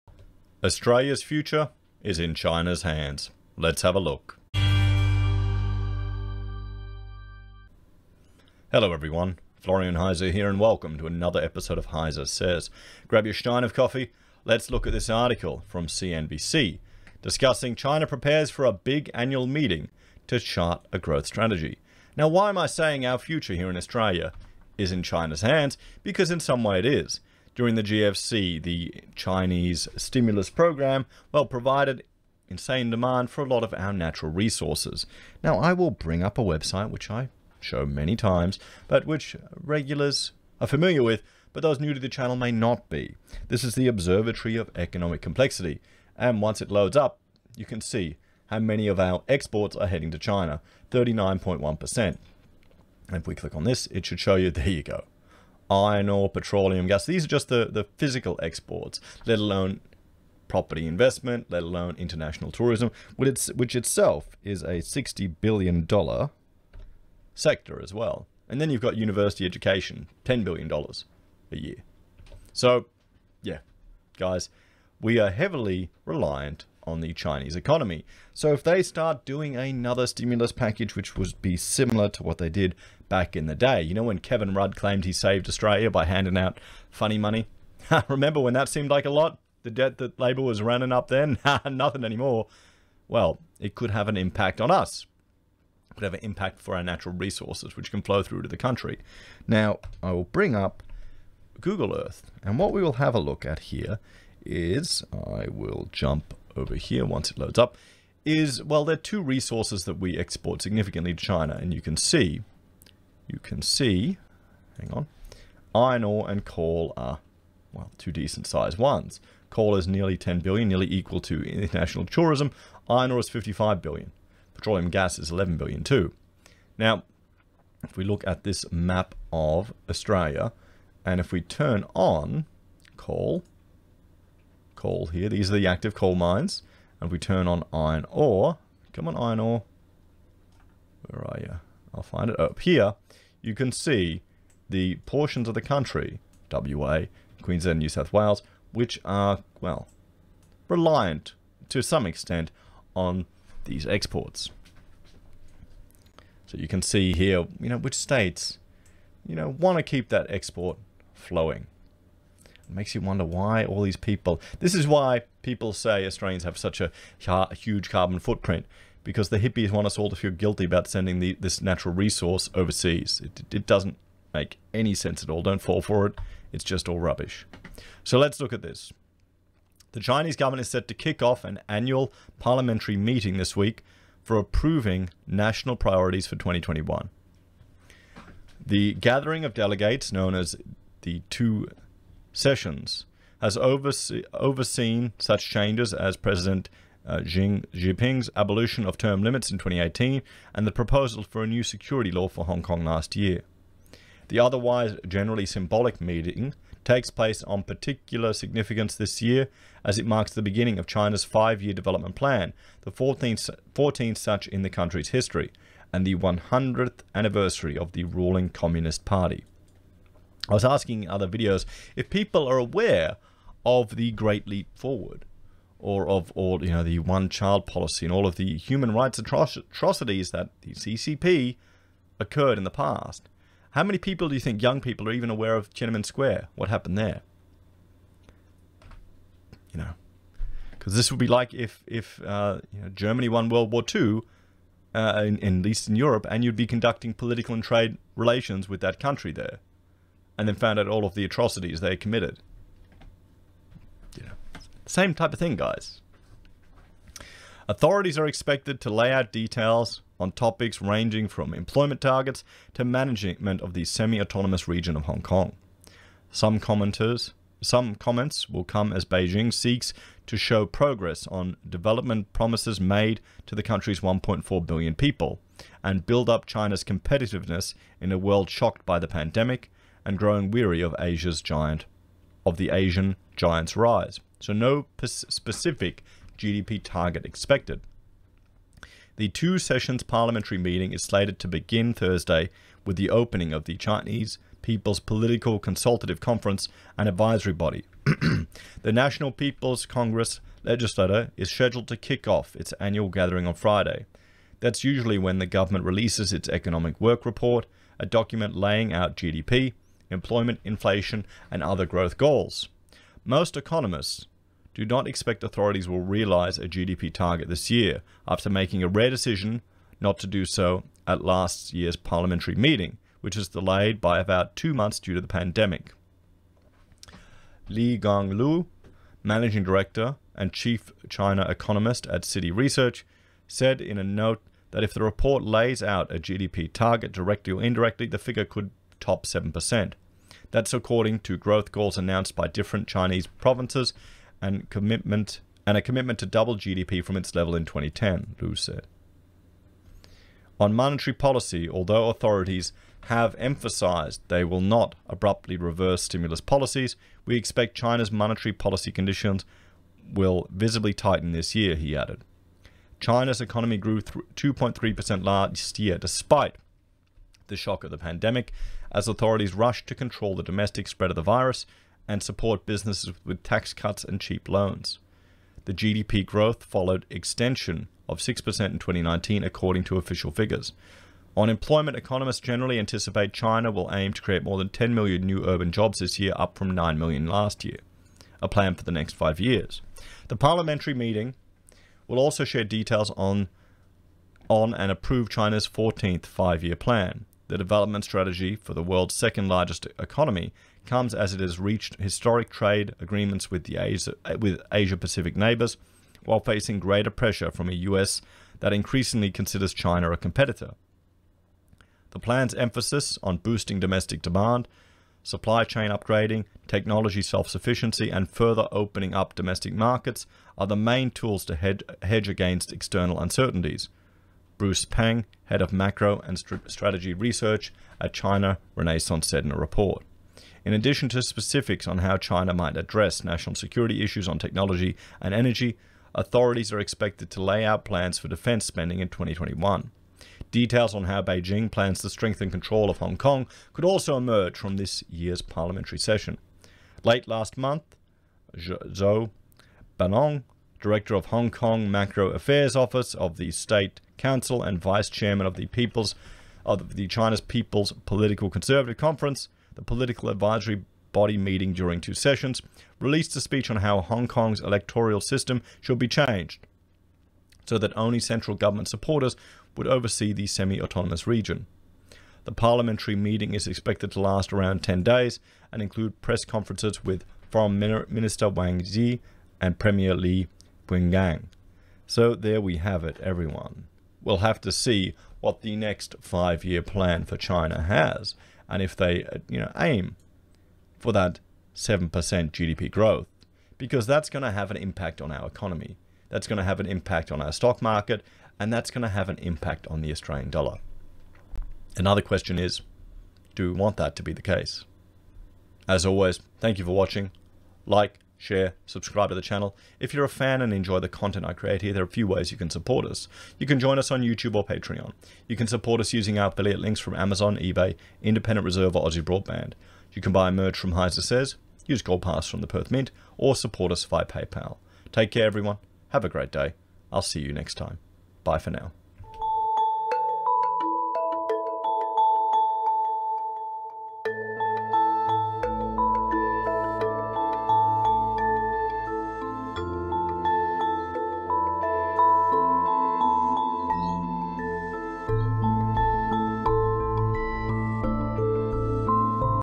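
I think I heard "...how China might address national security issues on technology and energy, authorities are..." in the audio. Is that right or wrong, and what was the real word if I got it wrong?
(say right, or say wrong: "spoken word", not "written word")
right.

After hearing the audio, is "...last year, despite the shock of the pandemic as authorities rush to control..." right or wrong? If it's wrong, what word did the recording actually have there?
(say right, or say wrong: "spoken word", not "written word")
right.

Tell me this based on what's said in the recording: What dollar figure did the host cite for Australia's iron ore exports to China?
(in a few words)
55 billion.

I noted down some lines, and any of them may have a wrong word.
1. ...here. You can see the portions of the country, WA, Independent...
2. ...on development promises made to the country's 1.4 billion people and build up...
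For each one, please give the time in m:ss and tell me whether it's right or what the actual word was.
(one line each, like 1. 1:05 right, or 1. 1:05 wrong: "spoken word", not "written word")
1. 2:22 wrong: "Queensland", not "Independent"
2. 4:31 right.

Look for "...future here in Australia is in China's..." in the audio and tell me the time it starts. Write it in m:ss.
0:23.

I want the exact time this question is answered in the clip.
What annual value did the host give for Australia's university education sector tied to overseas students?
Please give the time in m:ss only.
1:10.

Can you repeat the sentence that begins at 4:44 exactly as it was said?
So no specific GDP target expected.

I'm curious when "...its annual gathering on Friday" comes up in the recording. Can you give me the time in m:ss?
5:02.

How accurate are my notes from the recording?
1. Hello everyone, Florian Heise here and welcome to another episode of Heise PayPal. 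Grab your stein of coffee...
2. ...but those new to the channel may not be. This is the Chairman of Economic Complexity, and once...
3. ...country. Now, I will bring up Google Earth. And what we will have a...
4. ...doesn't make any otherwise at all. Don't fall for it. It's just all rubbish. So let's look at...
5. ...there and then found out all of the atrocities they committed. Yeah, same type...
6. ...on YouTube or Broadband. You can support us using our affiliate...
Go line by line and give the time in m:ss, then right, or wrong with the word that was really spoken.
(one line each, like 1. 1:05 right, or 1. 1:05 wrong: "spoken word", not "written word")
1. 0:08 wrong: "Says", not "PayPal"
2. 0:41 wrong: "Observatory", not "Chairman"
3. 1:38 right
4. 2:53 wrong: "sense", not "otherwise"
5. 4:09 right
6. 8:34 wrong: "Patreon", not "Broadband".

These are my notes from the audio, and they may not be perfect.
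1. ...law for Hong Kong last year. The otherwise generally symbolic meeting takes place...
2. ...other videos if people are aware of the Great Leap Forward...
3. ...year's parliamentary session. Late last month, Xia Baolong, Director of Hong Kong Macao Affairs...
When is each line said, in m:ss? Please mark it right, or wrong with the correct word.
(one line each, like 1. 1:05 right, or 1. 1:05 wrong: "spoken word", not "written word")
1. 3:22 right
2. 3:41 right
3. 7:25 right.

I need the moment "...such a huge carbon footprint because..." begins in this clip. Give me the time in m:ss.
2:46.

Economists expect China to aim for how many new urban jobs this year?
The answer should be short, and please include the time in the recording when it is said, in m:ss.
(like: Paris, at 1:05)
more than 10 million, at 6:24.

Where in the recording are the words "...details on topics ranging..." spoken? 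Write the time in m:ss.
4:19.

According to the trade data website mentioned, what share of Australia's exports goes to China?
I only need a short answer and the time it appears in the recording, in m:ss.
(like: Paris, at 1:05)
39.1%, at 0:50.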